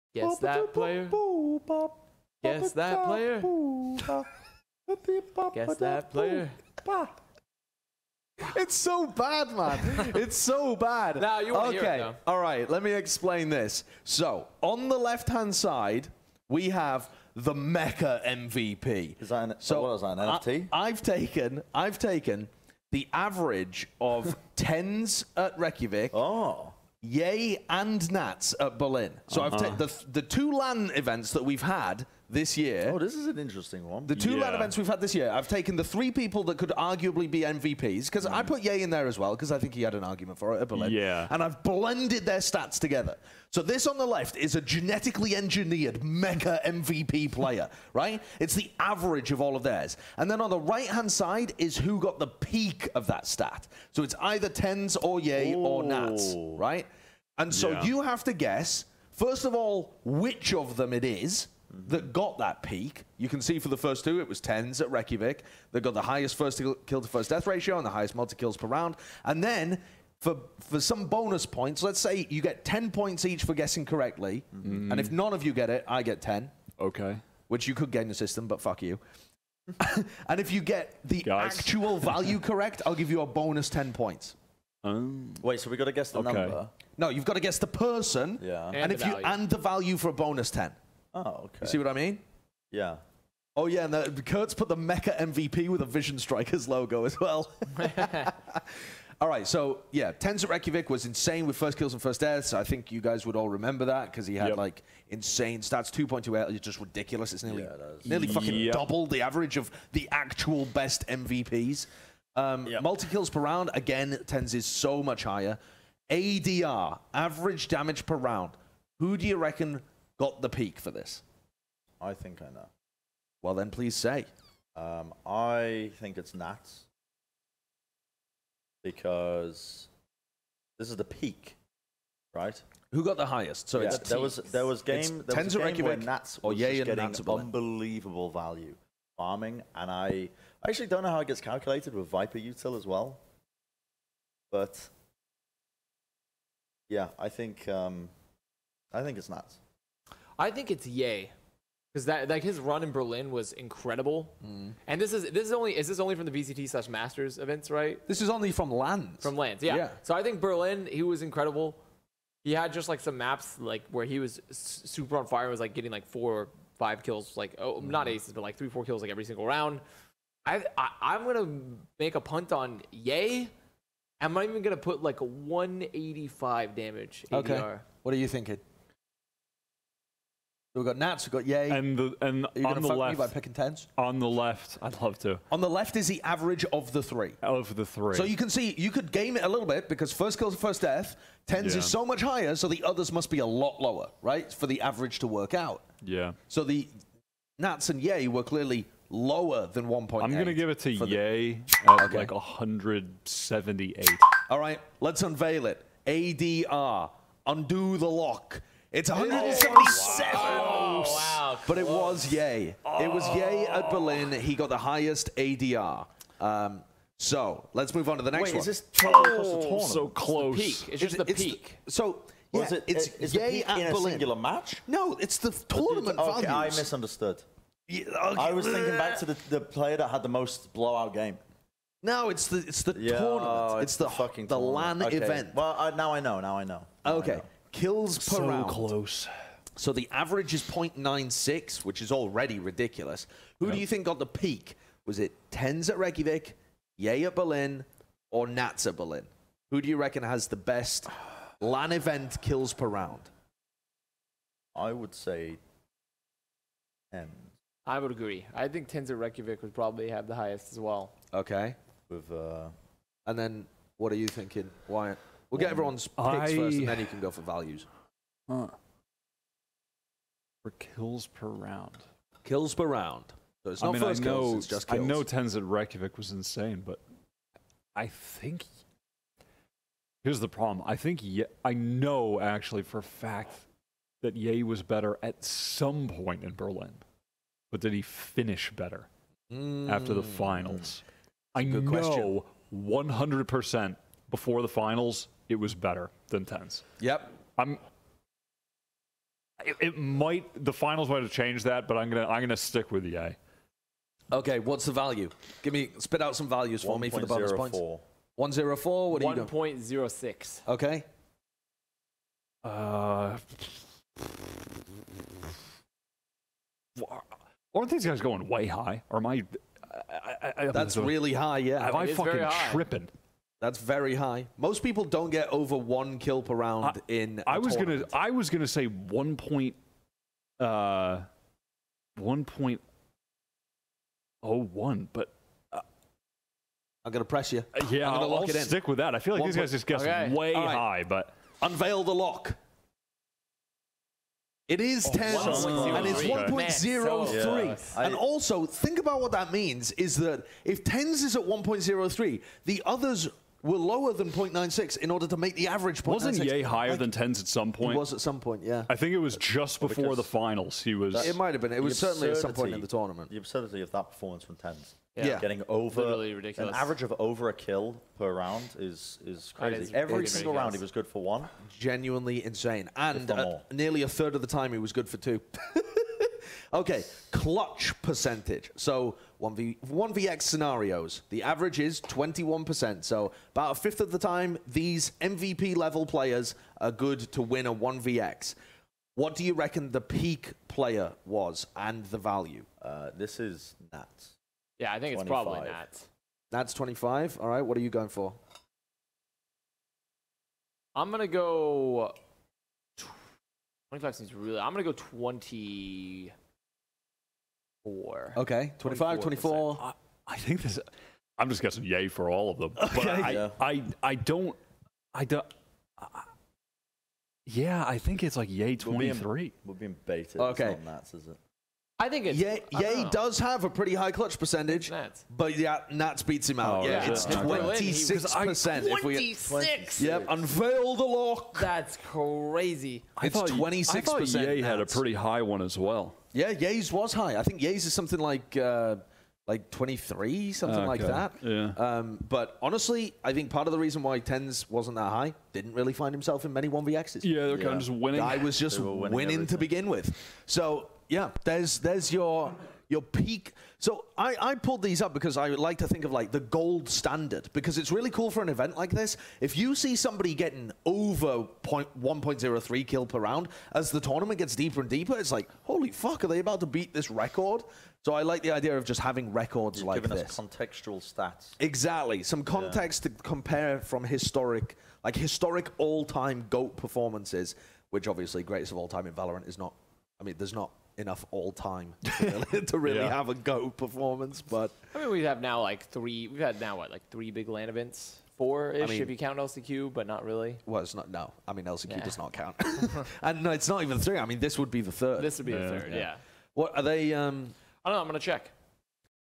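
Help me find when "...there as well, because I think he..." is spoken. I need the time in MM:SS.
00:38.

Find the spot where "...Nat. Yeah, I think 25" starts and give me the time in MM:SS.
06:33.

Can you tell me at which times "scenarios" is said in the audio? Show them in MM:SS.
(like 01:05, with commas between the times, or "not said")
06:20.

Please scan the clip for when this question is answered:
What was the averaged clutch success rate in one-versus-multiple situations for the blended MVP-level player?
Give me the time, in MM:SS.
06:22.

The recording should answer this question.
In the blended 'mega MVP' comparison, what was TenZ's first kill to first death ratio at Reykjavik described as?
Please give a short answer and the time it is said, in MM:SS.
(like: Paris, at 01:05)
2.2, at 01:45.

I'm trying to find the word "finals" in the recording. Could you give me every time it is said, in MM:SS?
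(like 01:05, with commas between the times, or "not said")
04:50, 04:54, 05:00, 06:00.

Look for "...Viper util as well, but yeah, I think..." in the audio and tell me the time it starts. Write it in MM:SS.
02:22.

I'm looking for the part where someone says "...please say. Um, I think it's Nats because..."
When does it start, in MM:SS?
02:03.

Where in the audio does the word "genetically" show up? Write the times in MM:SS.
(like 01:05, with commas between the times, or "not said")
00:44.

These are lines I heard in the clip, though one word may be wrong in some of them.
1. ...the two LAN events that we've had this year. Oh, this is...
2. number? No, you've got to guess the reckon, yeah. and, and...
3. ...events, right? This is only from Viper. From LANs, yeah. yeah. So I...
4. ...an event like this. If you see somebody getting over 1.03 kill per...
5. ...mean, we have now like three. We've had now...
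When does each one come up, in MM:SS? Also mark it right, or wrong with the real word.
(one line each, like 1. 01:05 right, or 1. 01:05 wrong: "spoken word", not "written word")
1. 00:30 right
2. 01:26 wrong: "person", not "reckon"
3. 02:37 wrong: "LANs", not "Viper"
4. 07:38 right
5. 08:04 right.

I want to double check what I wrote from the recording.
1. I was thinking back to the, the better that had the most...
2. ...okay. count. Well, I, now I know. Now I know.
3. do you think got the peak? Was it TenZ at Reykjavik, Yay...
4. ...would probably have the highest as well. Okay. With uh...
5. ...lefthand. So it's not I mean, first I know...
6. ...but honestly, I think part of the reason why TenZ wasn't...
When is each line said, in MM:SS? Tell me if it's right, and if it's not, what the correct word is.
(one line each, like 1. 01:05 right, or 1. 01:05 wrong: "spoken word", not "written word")
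1. 03:48 wrong: "player", not "better"
2. 03:55 wrong: "event", not "count"
3. 04:03 right
4. 04:19 right
5. 04:32 wrong: "round", not "lefthand"
6. 07:22 right.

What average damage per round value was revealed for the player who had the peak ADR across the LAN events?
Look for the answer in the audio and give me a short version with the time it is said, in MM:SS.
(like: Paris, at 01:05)
177, at 03:28.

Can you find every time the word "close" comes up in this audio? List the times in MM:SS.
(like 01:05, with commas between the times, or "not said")
03:40, 03:58.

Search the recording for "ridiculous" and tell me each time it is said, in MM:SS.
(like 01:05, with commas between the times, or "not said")
01:46, 04:02.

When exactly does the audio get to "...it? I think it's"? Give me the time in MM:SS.
07:01.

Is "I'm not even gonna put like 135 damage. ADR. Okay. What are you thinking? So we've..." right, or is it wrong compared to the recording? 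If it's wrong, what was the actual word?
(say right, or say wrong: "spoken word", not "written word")
wrong: "185", not "135".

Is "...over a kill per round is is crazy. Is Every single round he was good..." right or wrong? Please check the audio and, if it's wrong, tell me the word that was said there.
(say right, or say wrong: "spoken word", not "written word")
right.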